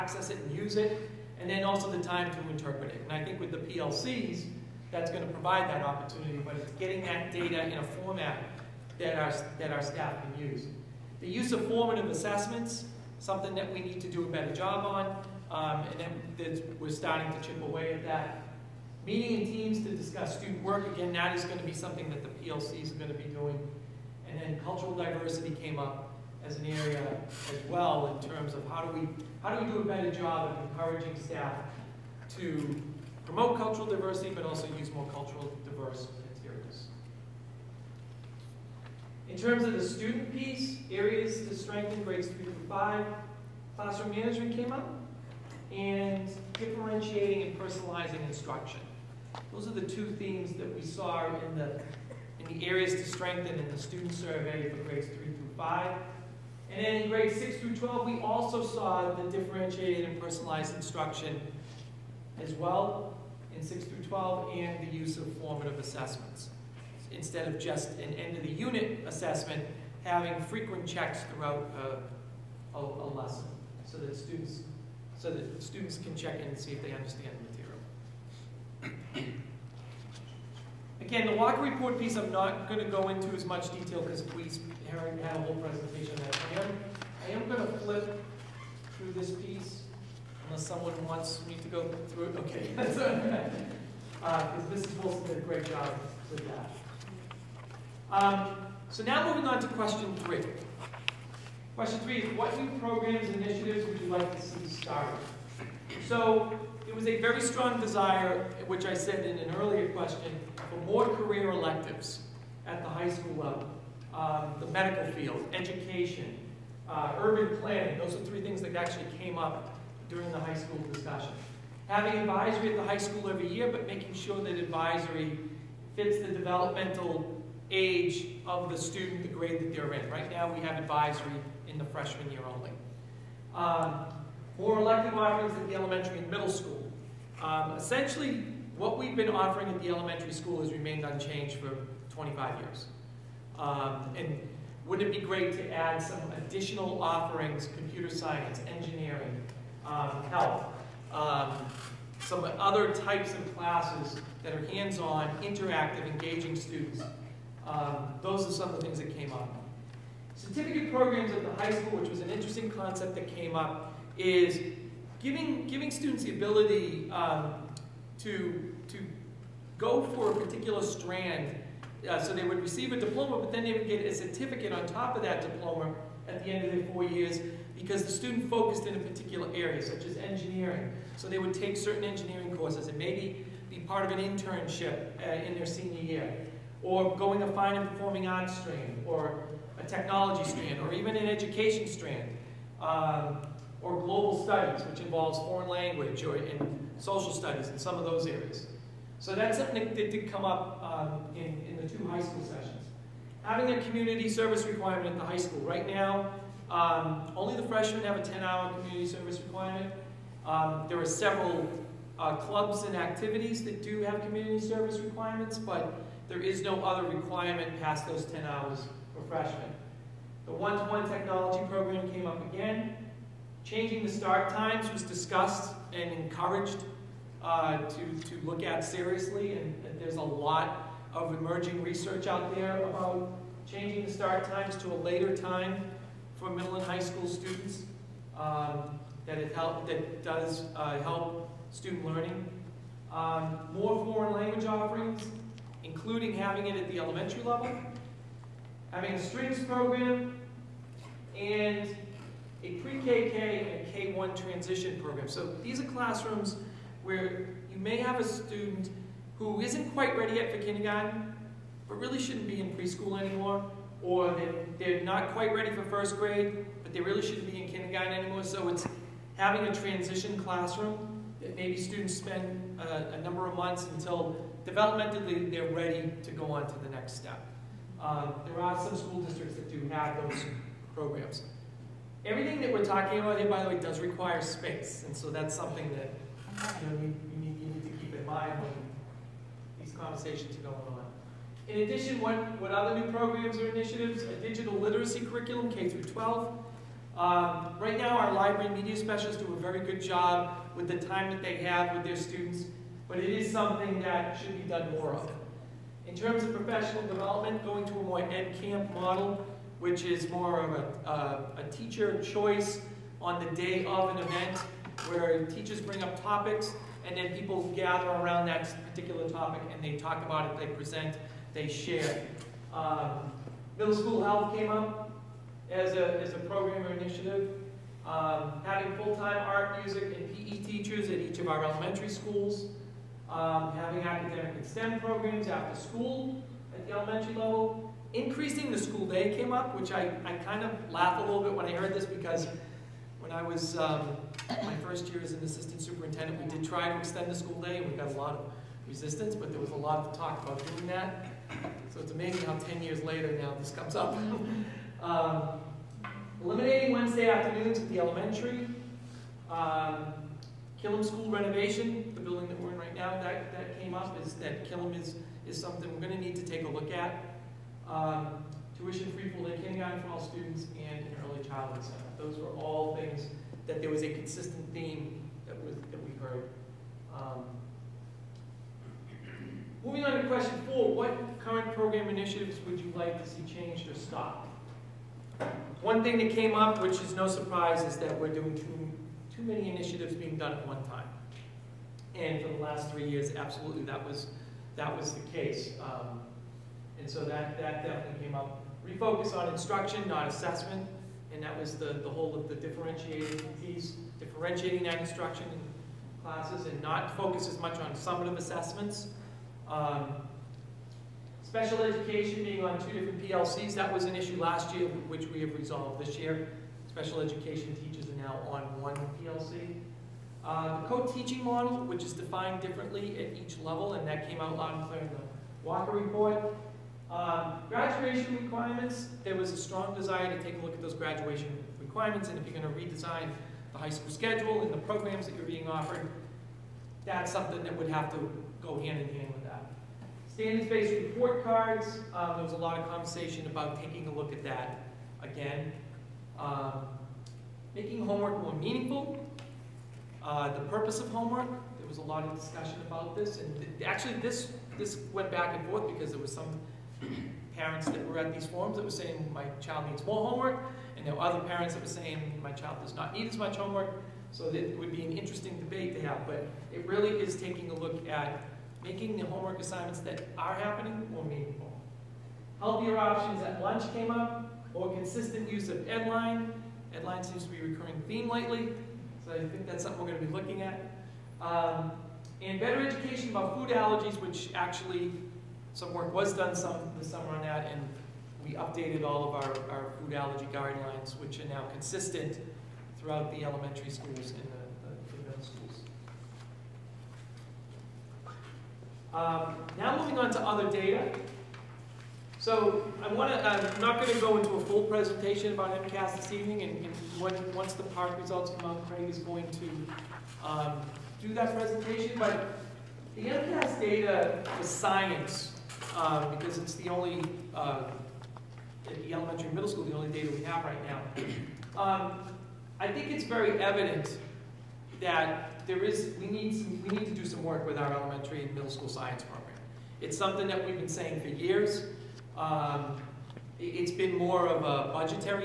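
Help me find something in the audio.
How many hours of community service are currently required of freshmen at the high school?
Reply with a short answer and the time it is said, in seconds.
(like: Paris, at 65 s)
10, at 208 s.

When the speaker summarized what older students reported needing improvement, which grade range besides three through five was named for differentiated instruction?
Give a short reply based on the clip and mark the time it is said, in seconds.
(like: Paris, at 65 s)
6 through 12, at 57 s.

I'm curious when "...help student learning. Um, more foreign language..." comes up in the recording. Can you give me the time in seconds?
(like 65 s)
241 s.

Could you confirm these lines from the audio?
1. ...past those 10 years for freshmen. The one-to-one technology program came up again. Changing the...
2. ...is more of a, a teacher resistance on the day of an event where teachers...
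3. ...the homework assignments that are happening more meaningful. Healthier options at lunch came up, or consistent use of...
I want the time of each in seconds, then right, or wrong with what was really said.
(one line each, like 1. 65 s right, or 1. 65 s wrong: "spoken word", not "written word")
1. 217 s wrong: "hours", not "years"
2. 310 s wrong: "choice", not "resistance"
3. 469 s right.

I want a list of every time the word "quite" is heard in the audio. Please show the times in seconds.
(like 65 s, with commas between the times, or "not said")
259 s, 265 s.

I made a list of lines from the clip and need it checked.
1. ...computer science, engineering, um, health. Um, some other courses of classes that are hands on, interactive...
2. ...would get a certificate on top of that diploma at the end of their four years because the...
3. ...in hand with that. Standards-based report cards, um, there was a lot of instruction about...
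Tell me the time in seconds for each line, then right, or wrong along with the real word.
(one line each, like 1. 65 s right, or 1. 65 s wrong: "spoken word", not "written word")
1. 147 s wrong: "types", not "courses"
2. 173 s right
3. 439 s wrong: "conversation", not "instruction".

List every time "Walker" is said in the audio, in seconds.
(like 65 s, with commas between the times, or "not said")
81 s, 425 s.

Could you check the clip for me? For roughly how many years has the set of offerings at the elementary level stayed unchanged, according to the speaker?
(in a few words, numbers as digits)
25.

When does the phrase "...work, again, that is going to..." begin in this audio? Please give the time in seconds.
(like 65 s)
20 s.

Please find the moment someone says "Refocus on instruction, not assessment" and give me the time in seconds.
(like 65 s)
398 s.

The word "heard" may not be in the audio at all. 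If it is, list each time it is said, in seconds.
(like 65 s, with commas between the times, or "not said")
341 s, 376 s.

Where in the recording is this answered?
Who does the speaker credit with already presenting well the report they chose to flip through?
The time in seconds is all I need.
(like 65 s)
94 s.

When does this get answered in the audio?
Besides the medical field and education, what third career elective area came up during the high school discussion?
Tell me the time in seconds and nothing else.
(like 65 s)
117 s.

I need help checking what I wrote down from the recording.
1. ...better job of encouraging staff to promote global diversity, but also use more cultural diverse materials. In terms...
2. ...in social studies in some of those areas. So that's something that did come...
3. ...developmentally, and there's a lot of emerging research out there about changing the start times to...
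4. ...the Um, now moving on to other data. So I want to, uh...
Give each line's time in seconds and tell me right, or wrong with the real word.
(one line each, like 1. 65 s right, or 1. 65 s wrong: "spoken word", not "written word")
1. 29 s wrong: "cultural", not "global"
2. 196 s right
3. 228 s wrong: "seriously", not "developmentally"
4. 494 s right.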